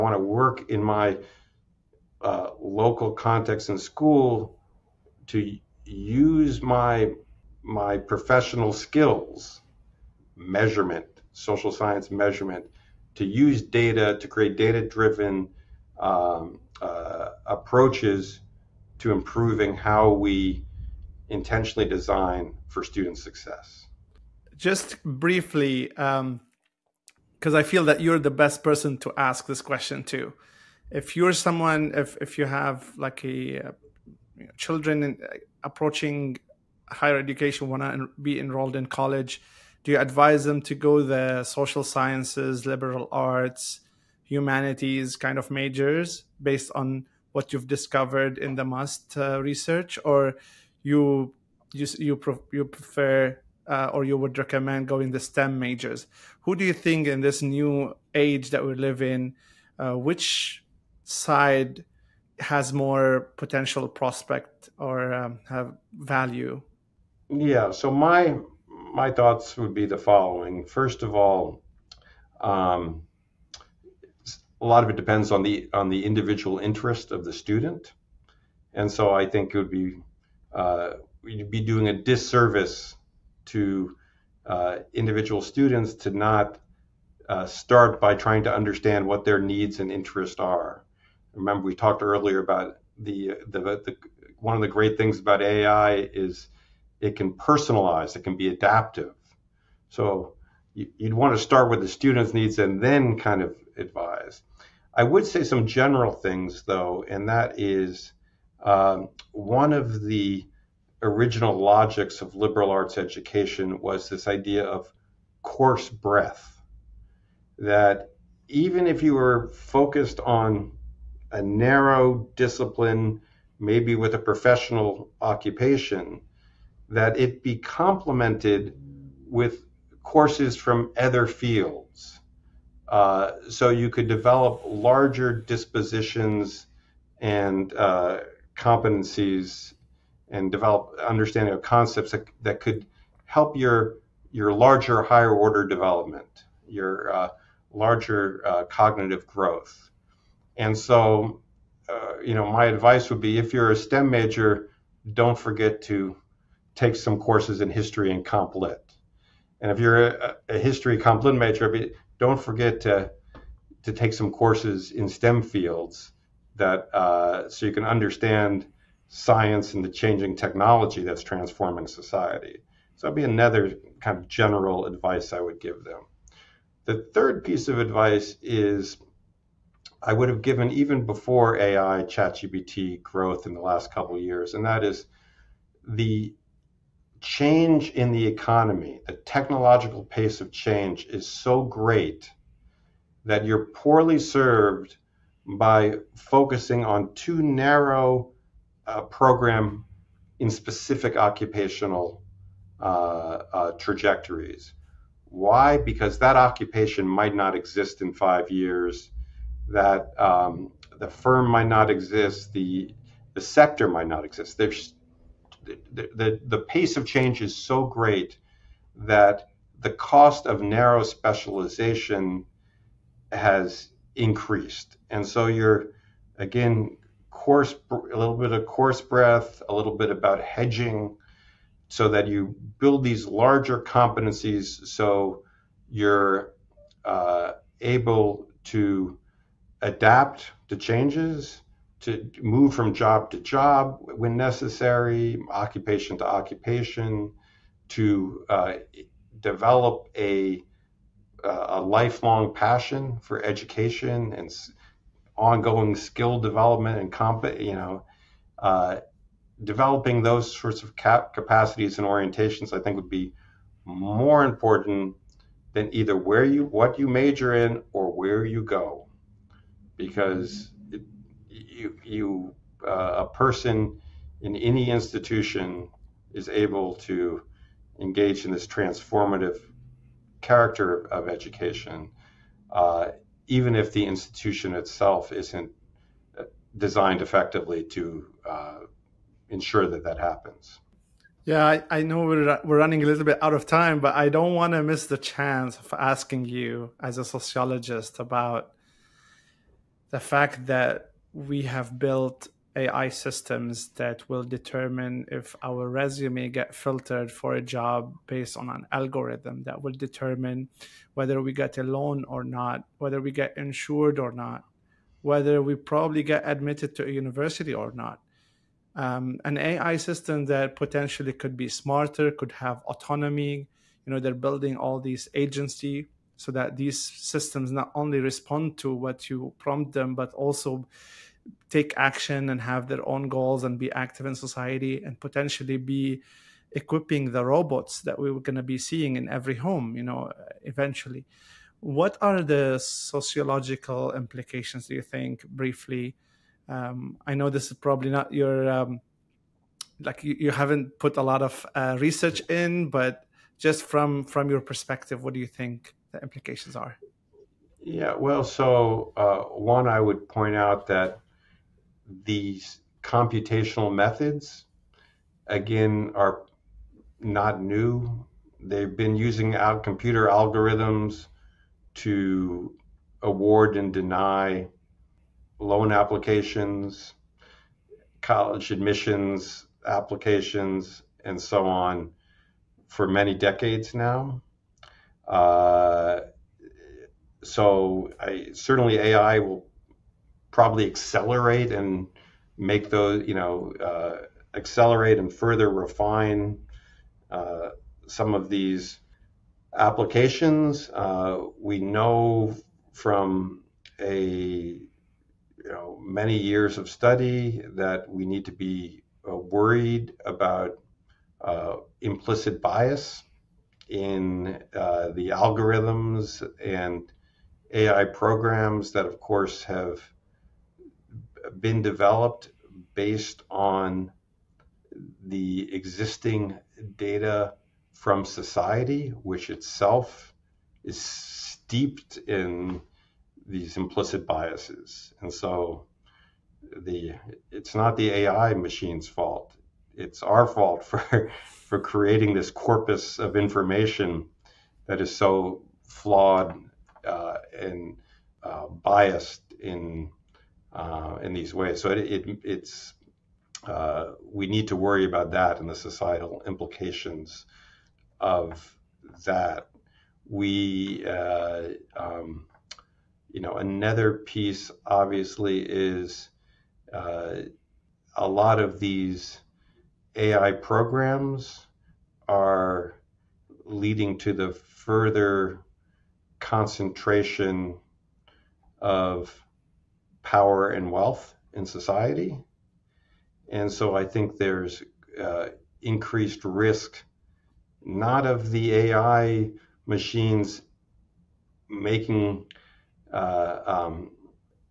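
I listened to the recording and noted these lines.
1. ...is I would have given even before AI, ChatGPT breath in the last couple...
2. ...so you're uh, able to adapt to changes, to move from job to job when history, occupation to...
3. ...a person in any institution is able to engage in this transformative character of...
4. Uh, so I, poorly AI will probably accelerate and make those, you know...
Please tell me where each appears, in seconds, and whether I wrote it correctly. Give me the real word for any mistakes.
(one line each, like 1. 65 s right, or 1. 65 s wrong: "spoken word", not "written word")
1. 178 s wrong: "growth", not "breath"
2. 234 s wrong: "necessary", not "history"
3. 273 s right
4. 385 s wrong: "certainly", not "poorly".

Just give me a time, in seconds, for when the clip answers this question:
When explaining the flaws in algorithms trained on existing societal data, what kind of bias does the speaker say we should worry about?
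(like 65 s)
412 s.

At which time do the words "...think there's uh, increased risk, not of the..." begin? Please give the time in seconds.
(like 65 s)
484 s.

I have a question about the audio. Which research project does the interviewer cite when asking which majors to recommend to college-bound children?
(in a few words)
MUST.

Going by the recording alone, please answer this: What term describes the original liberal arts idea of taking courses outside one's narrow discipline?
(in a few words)
course breadth.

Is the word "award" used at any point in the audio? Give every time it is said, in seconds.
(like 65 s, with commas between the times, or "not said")
373 s.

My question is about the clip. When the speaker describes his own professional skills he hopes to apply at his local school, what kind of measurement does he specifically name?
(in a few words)
social science measurement.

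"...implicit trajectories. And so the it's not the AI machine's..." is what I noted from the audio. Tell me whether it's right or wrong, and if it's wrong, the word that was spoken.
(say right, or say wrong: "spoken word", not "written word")
wrong: "biases", not "trajectories".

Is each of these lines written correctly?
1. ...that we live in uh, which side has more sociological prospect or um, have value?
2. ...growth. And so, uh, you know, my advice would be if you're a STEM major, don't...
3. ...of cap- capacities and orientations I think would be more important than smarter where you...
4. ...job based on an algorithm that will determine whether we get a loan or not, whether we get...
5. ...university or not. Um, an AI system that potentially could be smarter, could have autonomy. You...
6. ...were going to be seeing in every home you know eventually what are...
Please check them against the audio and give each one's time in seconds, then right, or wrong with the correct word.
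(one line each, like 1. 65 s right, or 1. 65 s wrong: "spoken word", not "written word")
1. 58 s wrong: "potential", not "sociological"
2. 149 s right
3. 260 s wrong: "either", not "smarter"
4. 307 s right
5. 317 s right
6. 338 s right.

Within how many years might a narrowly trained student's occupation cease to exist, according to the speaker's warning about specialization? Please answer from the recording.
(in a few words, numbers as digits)
5.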